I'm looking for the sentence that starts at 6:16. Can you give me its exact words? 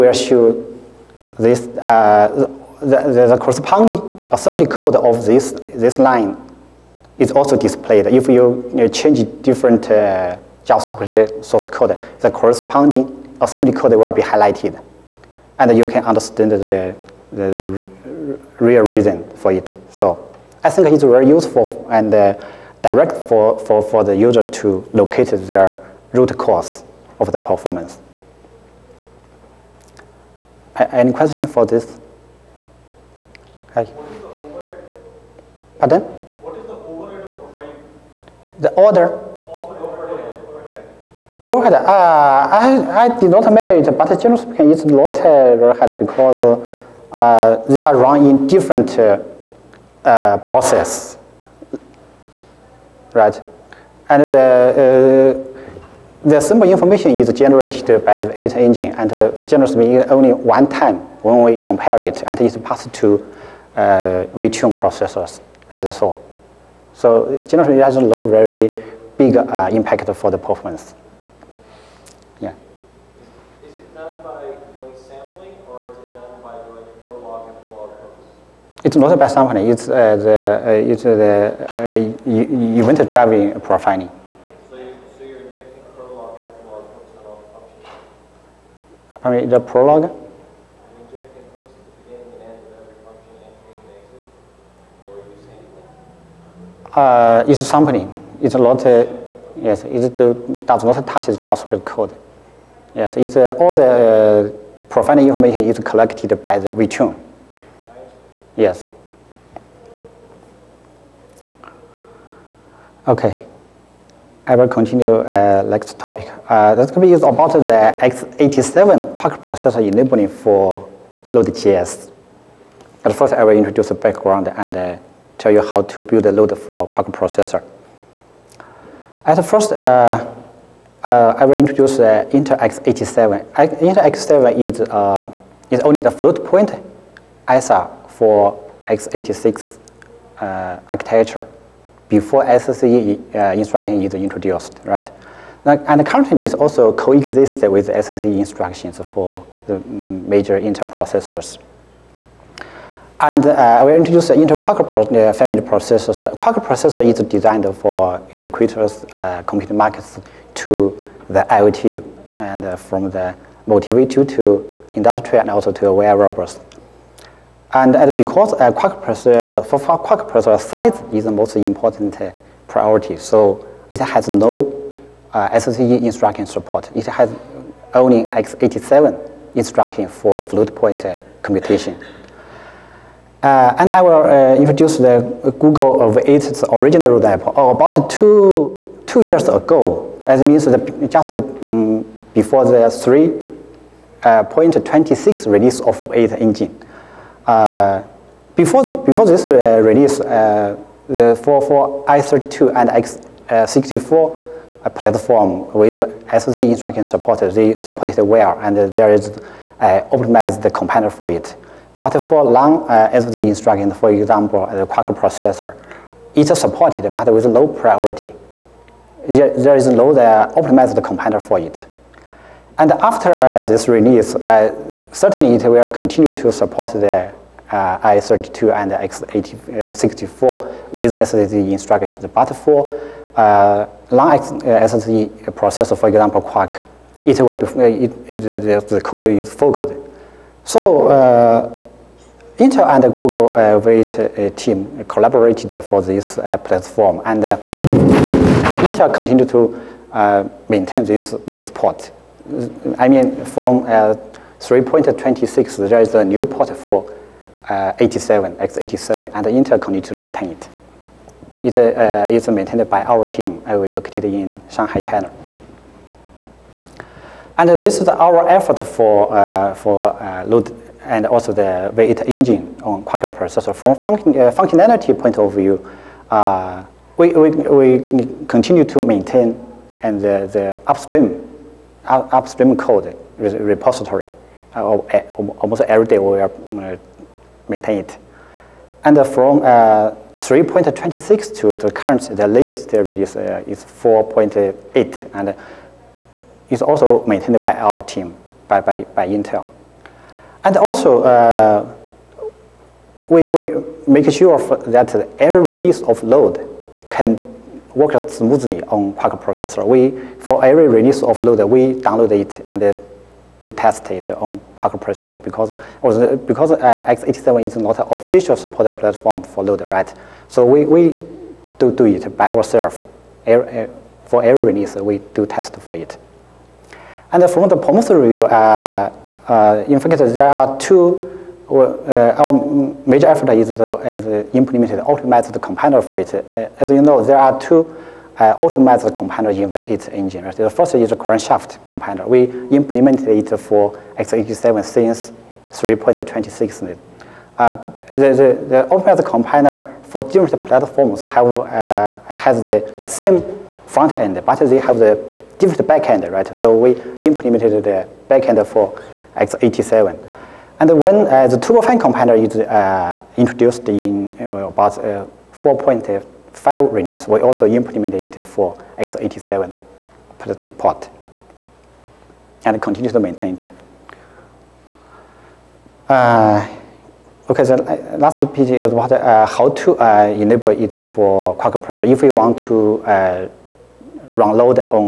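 Uh, okay, the so last piece is what, how to enable it for Quark processor.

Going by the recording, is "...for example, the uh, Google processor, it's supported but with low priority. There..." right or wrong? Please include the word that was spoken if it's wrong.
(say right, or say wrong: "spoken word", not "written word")
wrong: "Quark", not "Google".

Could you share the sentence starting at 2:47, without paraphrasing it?
And uh, because uh, Quark processor, for Quark processor size is the most important priority, so it has no uh, instruction support.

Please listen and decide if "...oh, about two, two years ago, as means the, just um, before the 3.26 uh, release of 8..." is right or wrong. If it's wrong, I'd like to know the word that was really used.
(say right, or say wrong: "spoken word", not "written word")
right.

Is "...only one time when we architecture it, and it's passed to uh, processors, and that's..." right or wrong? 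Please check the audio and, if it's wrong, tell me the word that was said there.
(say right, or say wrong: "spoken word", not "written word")
wrong: "compare", not "architecture".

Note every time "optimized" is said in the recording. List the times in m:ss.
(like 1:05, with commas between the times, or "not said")
3:29, 3:40.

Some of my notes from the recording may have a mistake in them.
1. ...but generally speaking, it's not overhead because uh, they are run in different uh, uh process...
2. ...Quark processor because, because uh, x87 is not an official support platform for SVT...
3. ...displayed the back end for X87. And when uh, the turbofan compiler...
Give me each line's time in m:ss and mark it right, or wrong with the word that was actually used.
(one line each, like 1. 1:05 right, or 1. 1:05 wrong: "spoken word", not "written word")
1. 0:43 right
2. 5:14 wrong: "Node", not "SVT"
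3. 5:57 wrong: "implemented", not "displayed".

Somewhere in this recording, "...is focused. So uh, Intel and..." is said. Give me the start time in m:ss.
3:59.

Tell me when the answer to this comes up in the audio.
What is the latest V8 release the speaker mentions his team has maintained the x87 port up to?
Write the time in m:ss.
4:53.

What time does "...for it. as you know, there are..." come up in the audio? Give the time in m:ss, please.
5:36.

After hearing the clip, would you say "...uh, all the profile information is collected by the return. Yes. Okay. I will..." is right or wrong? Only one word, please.
right.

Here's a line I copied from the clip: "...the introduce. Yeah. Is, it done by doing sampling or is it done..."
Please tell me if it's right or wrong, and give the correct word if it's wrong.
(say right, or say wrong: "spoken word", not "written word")
wrong: "performance", not "introduce".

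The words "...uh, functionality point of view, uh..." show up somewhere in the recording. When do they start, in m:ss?
4:33.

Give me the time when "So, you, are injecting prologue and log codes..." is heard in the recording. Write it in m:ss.
1:24.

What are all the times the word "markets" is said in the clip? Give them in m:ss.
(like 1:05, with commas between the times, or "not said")
2:39.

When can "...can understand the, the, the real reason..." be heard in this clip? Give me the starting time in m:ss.
0:15.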